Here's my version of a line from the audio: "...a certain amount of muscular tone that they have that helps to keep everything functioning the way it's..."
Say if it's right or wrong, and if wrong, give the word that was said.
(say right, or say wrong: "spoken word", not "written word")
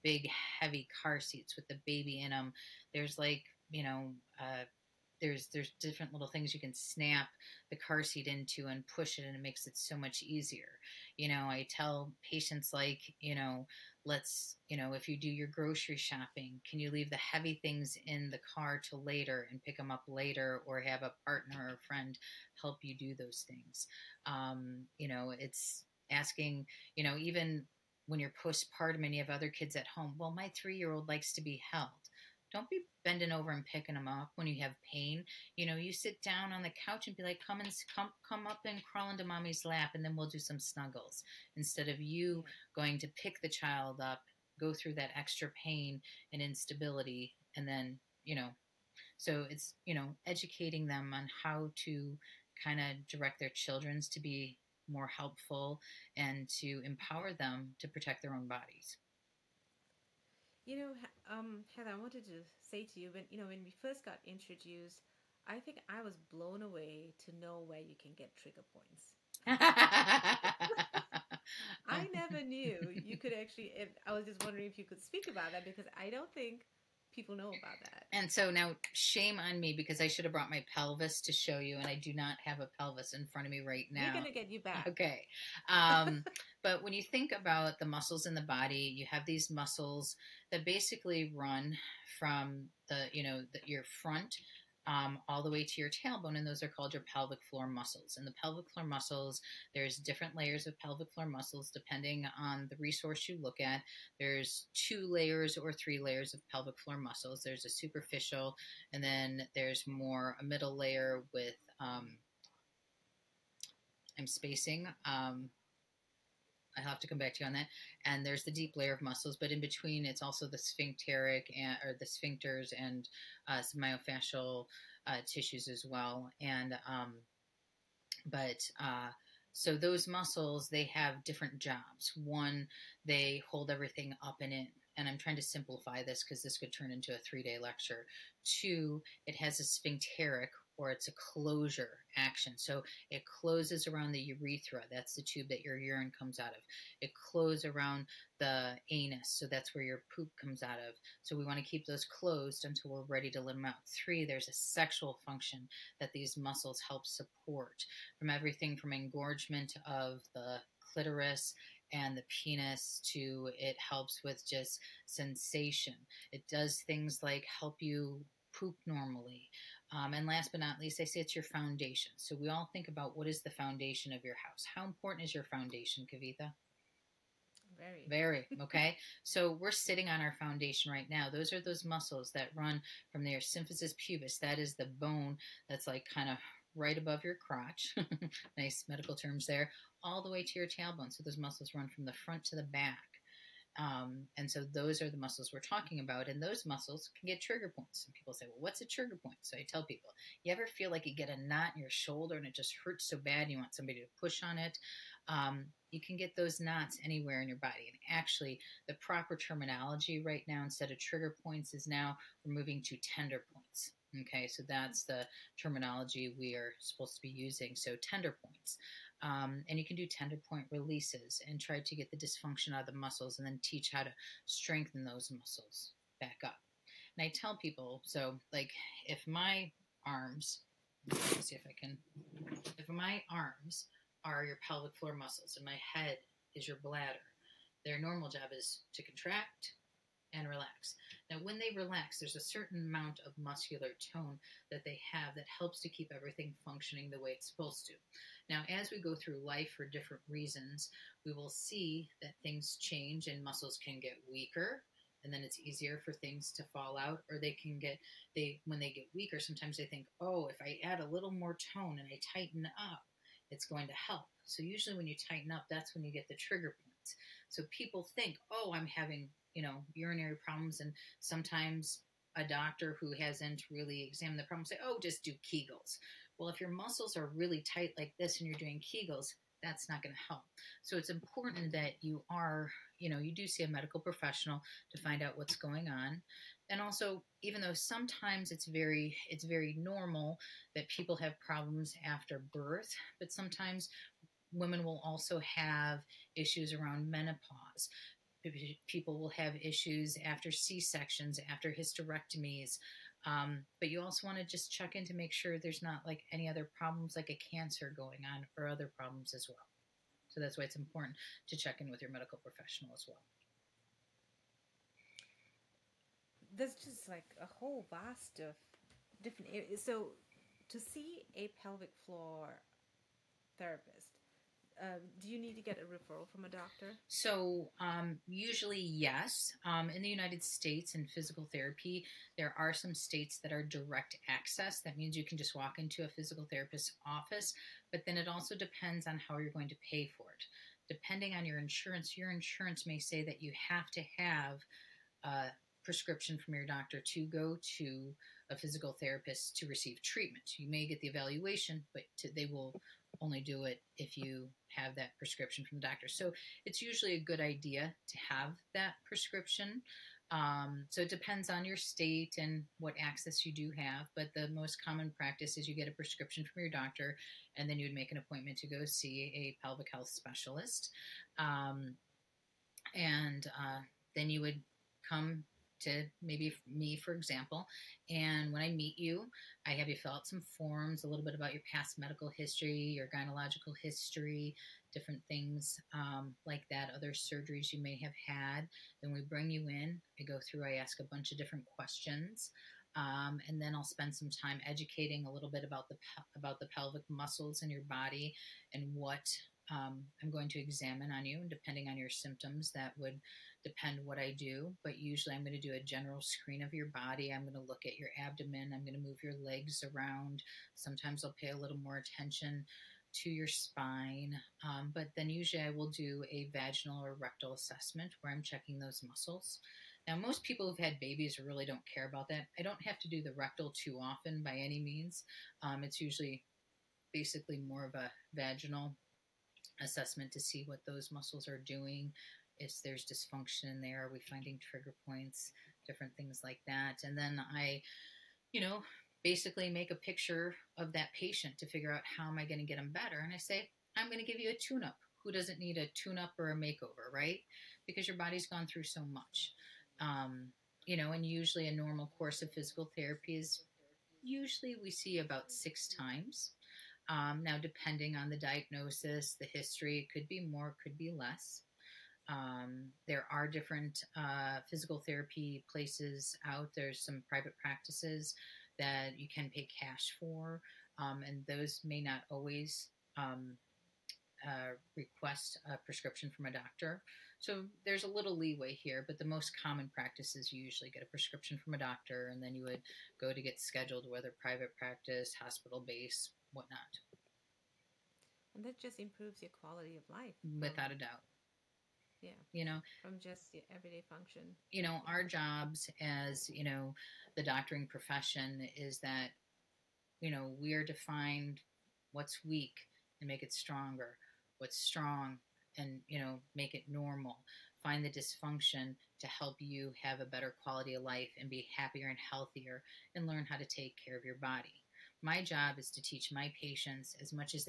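right.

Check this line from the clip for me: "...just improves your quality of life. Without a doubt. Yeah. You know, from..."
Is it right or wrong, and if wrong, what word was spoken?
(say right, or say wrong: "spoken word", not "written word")
right.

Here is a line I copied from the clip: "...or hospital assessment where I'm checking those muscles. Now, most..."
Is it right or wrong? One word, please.
wrong.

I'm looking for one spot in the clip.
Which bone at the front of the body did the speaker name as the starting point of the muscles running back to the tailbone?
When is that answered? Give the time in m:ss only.
3:03.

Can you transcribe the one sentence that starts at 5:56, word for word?
So it's usually a good idea to have that prescription.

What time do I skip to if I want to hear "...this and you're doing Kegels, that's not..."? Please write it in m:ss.
4:38.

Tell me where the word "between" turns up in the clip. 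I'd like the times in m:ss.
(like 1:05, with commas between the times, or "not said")
1:59.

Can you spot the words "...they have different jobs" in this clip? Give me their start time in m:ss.
2:10.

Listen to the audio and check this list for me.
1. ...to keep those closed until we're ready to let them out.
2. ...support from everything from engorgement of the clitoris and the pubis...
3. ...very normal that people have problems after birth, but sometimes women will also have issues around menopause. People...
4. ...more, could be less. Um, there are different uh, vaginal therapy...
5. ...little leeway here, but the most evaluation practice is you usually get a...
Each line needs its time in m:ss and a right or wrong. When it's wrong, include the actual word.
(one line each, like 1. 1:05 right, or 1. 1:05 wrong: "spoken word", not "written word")
1. 2:31 right
2. 2:37 wrong: "penis", not "pubis"
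3. 4:49 right
4. 7:40 wrong: "physical", not "vaginal"
5. 7:58 wrong: "common", not "evaluation".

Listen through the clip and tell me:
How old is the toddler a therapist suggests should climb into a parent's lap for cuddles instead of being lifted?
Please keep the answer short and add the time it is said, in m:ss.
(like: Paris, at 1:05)
3, at 0:30.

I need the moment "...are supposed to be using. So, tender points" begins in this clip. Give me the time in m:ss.
3:36.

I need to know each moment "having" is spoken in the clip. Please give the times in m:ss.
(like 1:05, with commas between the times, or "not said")
4:28.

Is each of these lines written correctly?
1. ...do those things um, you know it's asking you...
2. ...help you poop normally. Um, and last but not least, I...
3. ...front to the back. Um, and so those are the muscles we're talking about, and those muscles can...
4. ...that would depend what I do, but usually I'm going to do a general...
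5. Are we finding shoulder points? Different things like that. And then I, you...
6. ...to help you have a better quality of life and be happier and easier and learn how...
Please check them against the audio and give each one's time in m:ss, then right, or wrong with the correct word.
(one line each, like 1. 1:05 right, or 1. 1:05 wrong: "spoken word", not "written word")
1. 0:22 right
2. 2:47 right
3. 3:12 right
4. 6:42 right
5. 7:14 wrong: "trigger", not "shoulder"
6. 8:29 wrong: "healthier", not "easier".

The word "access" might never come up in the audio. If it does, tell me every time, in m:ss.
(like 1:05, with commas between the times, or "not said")
5:34, 6:03.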